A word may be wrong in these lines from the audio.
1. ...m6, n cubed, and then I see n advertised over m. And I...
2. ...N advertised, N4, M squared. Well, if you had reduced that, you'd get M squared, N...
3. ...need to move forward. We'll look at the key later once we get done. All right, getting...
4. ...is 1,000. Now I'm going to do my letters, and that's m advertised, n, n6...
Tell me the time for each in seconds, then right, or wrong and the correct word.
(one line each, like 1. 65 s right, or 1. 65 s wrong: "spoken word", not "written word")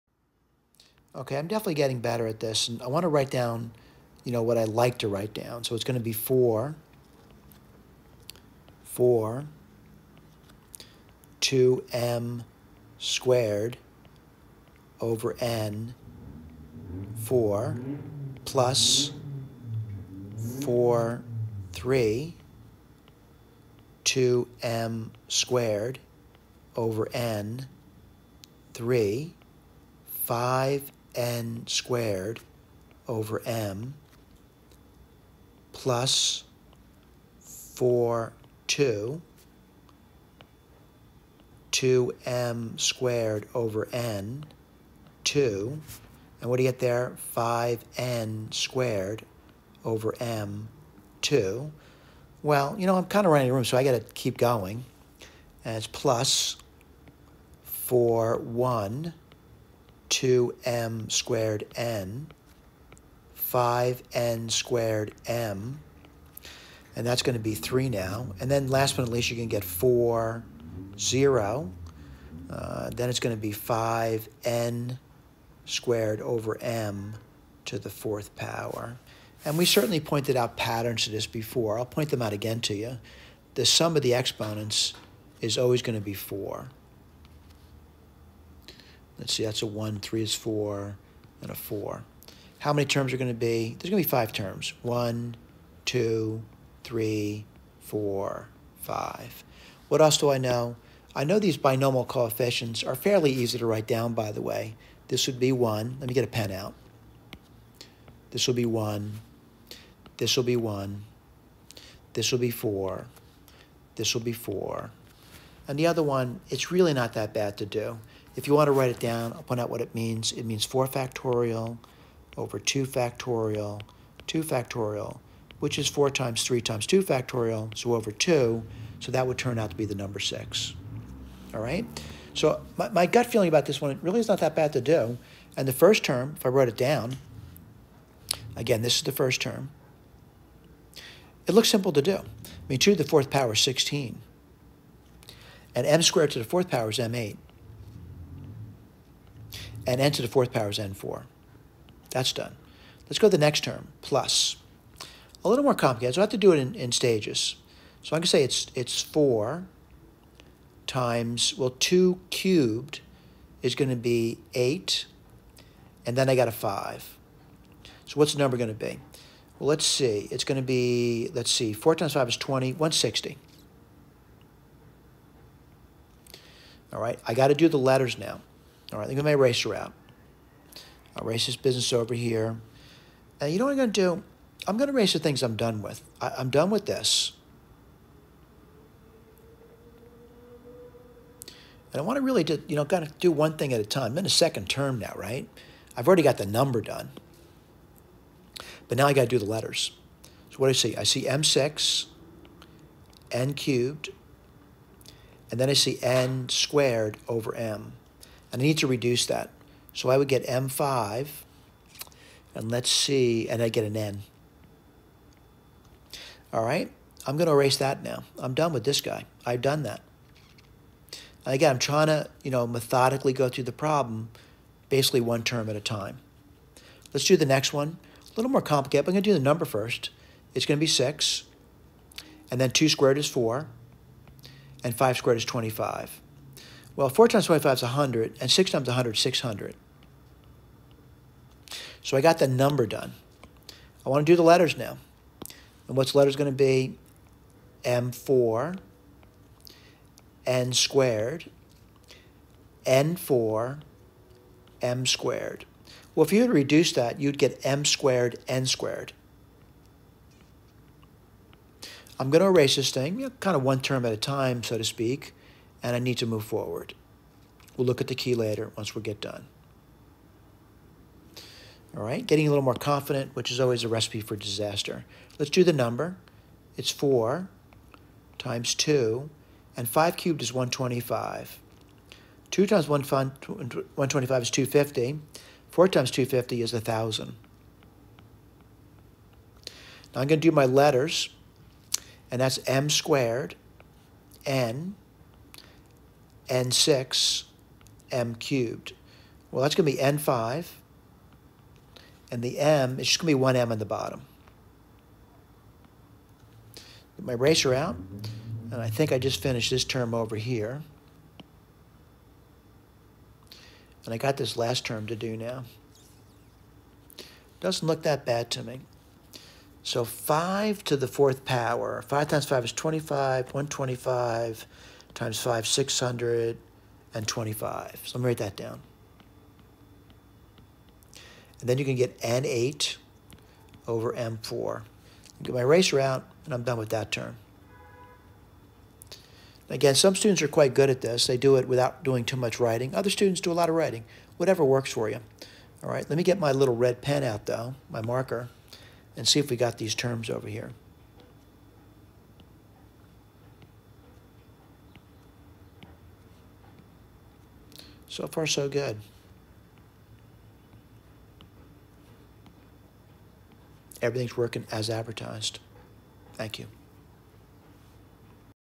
1. 201 s wrong: "squared", not "advertised"
2. 250 s wrong: "squared", not "advertised"
3. 265 s right
4. 286 s wrong: "squared", not "advertised".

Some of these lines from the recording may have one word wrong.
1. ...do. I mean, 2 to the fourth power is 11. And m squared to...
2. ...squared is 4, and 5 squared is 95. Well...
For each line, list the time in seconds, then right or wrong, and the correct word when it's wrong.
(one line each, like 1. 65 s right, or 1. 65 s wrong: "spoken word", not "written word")
1. 142 s wrong: "16", not "11"
2. 232 s wrong: "25", not "95".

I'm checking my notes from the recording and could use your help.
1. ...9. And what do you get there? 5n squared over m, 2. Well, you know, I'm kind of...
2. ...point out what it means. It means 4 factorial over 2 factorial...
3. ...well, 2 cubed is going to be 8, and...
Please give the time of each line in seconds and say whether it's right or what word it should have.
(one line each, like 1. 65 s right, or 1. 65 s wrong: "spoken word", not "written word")
1. 45 s wrong: "2", not "9"
2. 119 s right
3. 161 s right.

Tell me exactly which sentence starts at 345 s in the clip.
All right, let me get my little red pen out, though, my marker, and see if we got these terms over here.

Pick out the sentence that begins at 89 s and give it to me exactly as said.
Let's see, that's a 1, 3 is 4, and a 4.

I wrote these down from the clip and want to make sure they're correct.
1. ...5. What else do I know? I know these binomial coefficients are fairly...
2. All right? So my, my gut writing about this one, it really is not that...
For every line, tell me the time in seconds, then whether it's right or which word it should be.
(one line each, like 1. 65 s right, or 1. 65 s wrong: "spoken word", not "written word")
1. 98 s right
2. 131 s wrong: "feeling", not "writing".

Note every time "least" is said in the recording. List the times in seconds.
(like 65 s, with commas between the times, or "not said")
69 s.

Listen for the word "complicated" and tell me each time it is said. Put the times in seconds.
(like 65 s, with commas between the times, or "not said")
155 s, 228 s.